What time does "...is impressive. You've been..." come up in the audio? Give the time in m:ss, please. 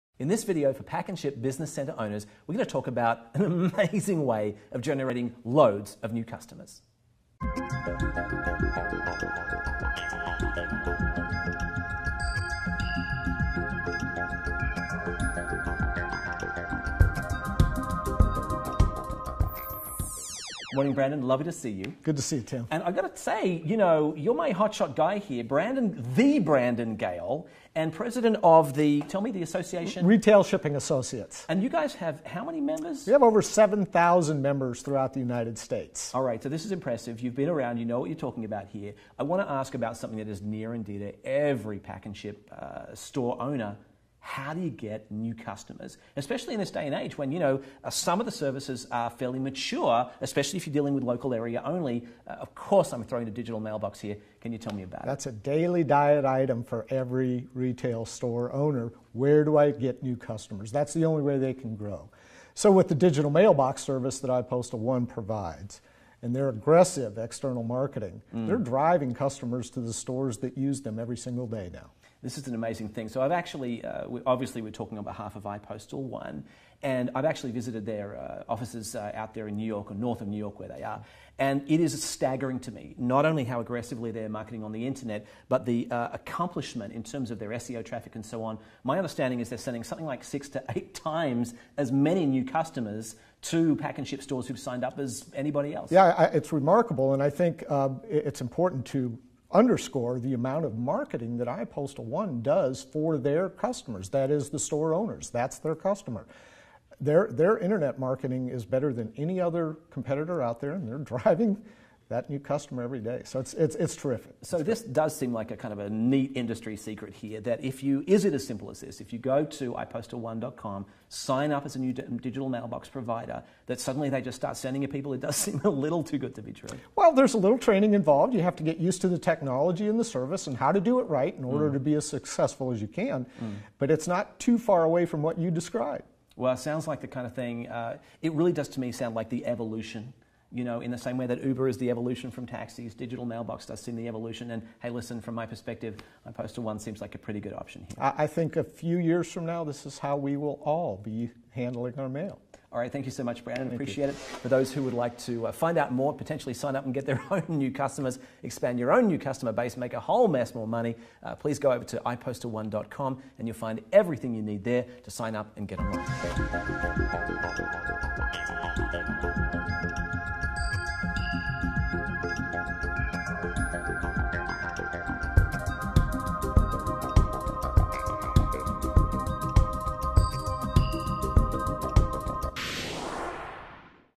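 0:36.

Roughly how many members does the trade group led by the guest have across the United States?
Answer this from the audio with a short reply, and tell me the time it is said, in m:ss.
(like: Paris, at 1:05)
Over 7,000, at 0:33.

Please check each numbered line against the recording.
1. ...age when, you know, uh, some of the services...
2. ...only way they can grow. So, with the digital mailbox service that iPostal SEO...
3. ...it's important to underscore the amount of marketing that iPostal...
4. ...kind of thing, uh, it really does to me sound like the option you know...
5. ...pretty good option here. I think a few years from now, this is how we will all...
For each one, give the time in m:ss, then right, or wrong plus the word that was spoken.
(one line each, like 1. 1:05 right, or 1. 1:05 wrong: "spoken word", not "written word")
1. 0:46 right
2. 1:01 wrong: "One", not "SEO"
3. 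1:38 right
4. 2:17 wrong: "evolution", not "option"
5. 2:27 right.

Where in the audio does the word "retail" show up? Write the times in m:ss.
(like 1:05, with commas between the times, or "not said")
0:30, 0:57.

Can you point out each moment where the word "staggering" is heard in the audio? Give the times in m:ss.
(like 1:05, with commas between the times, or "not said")
1:22.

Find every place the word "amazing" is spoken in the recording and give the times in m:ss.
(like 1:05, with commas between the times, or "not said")
0:03, 1:12.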